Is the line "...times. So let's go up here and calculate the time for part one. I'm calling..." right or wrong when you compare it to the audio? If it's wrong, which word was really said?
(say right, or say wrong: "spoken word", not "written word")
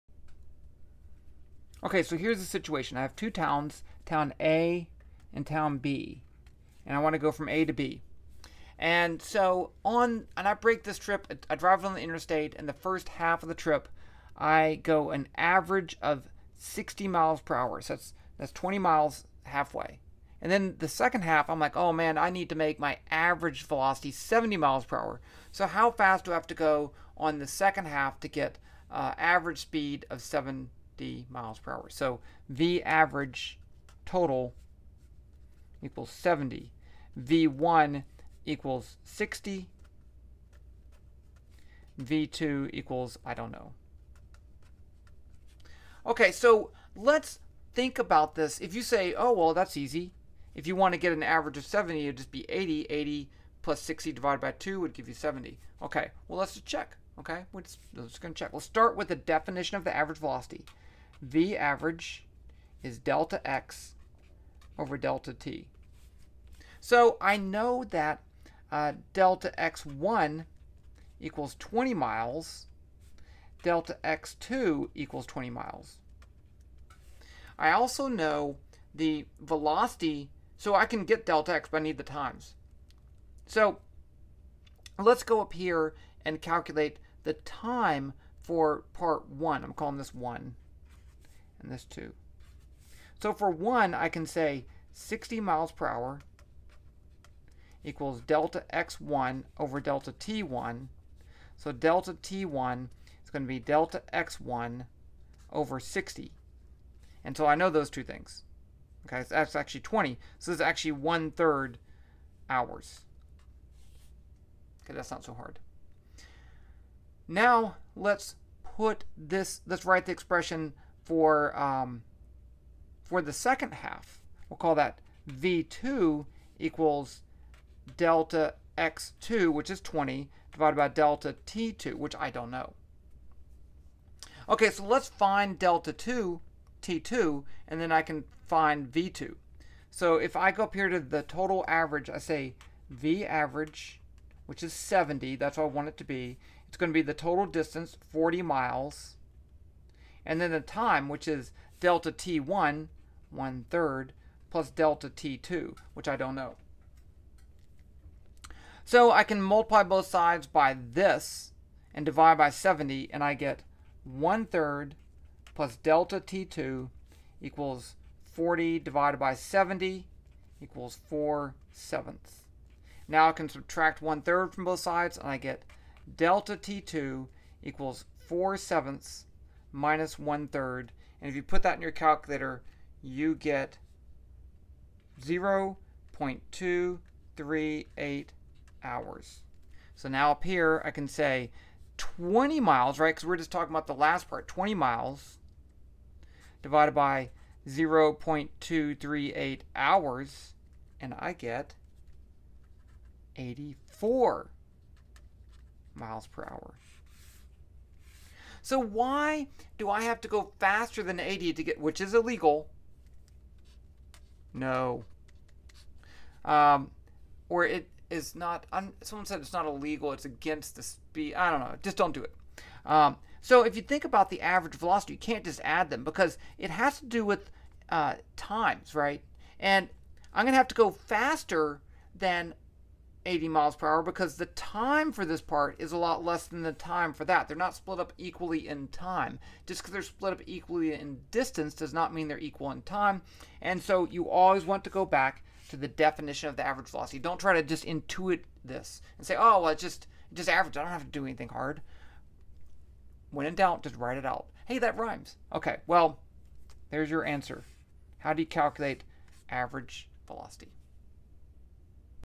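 right.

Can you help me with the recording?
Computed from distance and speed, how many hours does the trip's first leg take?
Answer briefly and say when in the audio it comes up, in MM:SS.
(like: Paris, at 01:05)
one-third hours, at 01:50.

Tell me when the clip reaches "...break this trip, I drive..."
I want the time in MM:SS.
00:10.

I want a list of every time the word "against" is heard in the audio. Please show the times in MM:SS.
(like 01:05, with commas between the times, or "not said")
03:40.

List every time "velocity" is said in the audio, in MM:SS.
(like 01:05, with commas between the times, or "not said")
00:23, 01:00, 01:19, 03:44, 04:06, 04:20.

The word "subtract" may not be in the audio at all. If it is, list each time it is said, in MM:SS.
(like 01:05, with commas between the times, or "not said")
02:53.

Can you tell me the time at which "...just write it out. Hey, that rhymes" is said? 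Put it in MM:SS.
04:13.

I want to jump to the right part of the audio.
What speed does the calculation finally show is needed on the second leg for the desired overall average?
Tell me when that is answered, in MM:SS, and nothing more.
03:23.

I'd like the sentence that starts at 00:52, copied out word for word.
80 plus 60 divided by 2 would give you 70.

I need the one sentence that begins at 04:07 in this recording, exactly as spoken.
Don't try to just intuit this and say, oh, well, it's just, just average.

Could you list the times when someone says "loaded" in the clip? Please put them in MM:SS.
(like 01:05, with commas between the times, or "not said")
not said.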